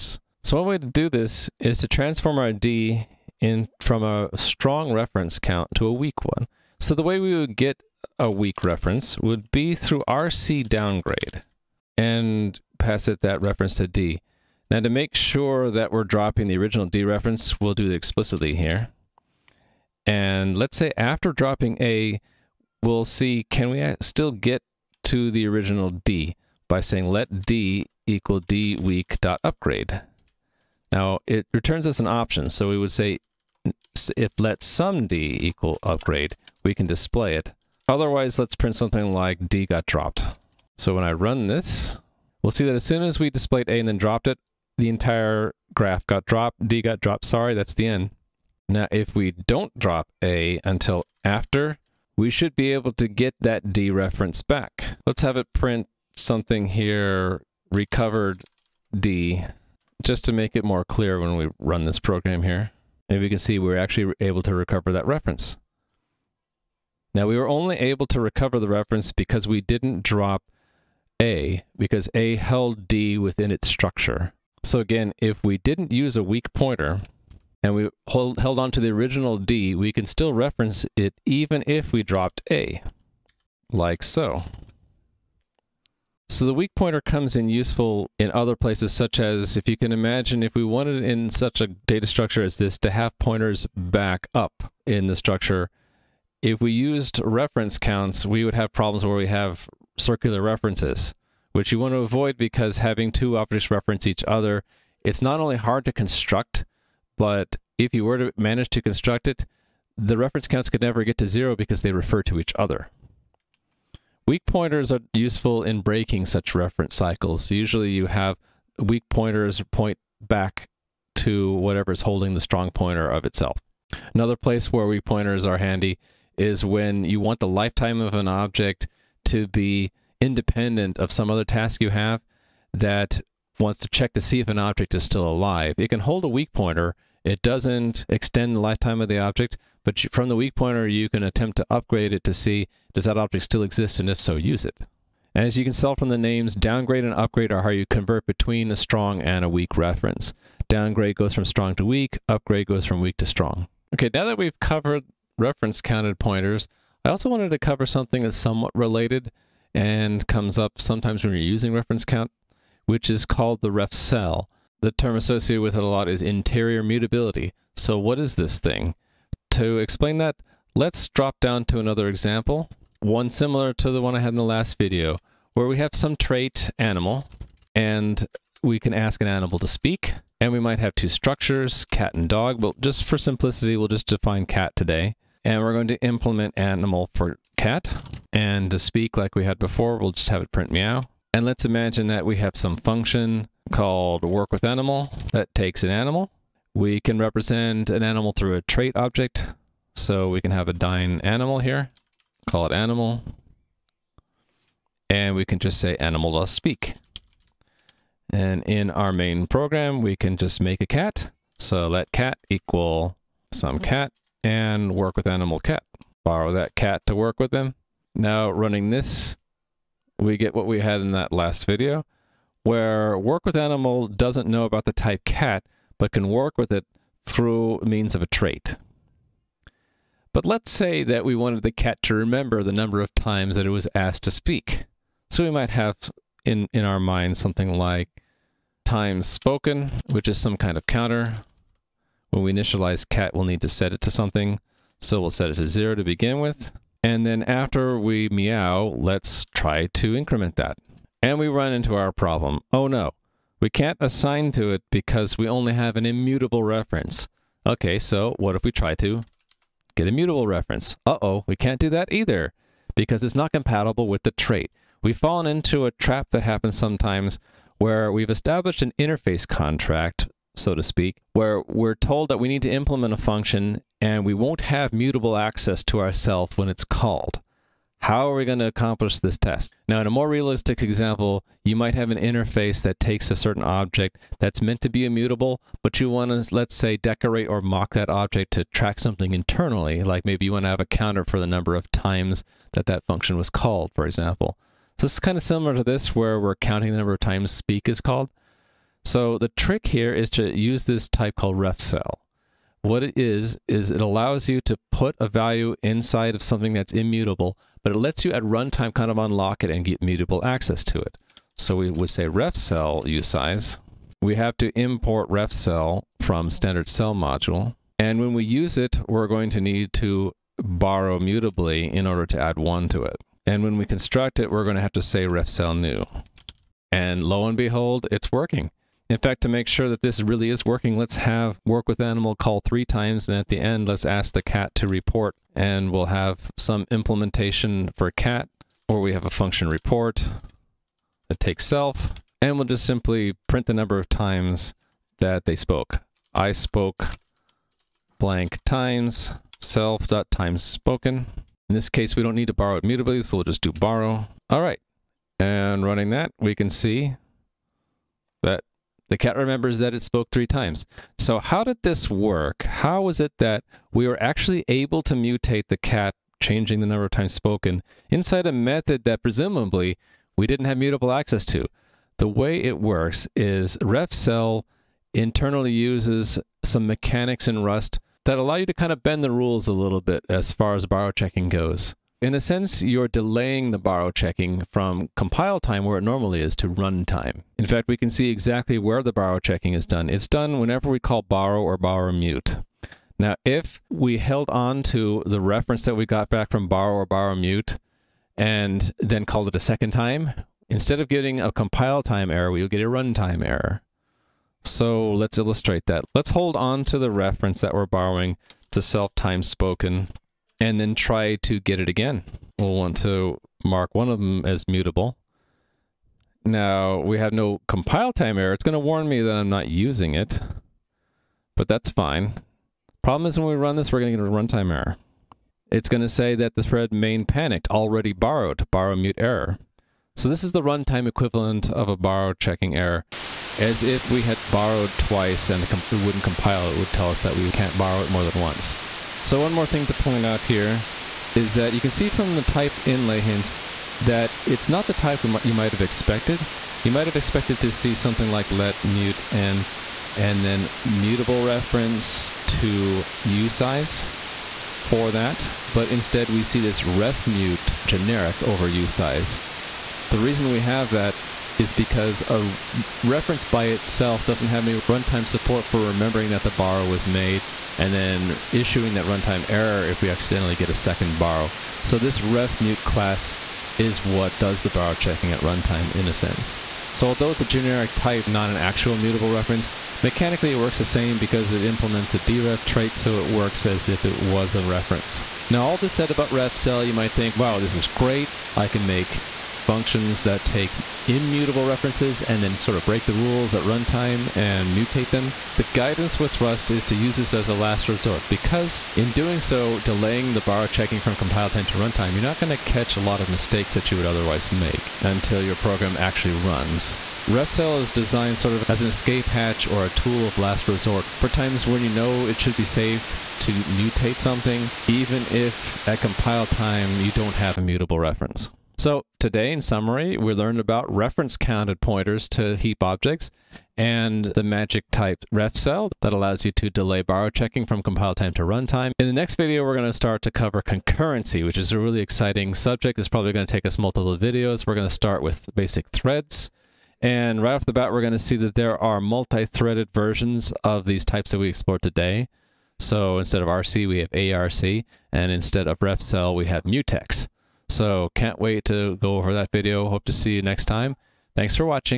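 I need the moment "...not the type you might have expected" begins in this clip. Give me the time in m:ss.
7:24.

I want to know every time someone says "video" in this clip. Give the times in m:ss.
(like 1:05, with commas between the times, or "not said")
2:54, 3:41, 8:49, 8:54, 9:09.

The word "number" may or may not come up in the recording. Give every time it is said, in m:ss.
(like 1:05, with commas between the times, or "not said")
3:52, 4:51, 4:56, 5:43, 6:06.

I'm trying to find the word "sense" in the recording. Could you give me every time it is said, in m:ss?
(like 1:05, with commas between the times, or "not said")
6:22, 7:56.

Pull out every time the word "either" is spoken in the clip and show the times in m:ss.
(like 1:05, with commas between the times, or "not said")
4:22.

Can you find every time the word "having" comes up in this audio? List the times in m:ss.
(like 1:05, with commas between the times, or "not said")
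1:42.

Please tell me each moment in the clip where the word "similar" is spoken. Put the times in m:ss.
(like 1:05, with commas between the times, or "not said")
2:53, 4:55.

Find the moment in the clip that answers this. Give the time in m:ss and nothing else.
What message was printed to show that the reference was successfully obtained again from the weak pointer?
0:57.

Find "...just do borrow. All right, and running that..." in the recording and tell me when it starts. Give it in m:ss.
5:53.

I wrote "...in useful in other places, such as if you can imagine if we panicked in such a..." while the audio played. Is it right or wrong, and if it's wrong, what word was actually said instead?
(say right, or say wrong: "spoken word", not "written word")
wrong: "wanted", not "panicked".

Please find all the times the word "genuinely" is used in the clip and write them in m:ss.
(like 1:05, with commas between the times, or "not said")
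not said.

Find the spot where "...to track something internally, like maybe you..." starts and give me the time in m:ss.
4:48.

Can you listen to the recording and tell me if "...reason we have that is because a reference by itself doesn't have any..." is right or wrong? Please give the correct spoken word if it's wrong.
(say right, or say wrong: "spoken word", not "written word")
right.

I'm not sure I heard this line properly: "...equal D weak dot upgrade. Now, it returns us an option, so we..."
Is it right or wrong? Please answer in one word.
right.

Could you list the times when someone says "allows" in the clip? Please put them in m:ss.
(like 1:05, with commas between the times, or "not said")
5:03, 6:18, 8:46.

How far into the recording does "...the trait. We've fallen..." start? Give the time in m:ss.
4:24.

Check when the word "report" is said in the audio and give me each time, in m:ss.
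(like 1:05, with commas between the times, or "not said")
5:34, 5:39.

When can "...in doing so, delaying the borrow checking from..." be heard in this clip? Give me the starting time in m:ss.
8:18.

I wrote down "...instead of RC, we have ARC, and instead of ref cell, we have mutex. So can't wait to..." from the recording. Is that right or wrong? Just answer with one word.
right.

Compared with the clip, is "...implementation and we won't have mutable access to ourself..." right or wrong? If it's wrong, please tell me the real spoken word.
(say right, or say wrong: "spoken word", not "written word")
wrong: "function", not "implementation".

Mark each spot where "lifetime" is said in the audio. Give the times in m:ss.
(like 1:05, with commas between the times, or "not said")
2:07, 2:18.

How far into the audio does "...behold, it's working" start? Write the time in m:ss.
5:27.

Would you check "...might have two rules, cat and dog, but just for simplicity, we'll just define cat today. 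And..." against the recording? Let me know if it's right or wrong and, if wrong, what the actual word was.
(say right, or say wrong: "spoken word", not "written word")
wrong: "structures", not "rules".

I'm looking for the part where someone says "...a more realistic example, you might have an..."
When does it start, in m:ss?
4:40.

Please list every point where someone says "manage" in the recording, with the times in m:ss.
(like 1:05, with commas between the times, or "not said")
1:48.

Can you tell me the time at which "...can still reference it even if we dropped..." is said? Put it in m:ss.
1:19.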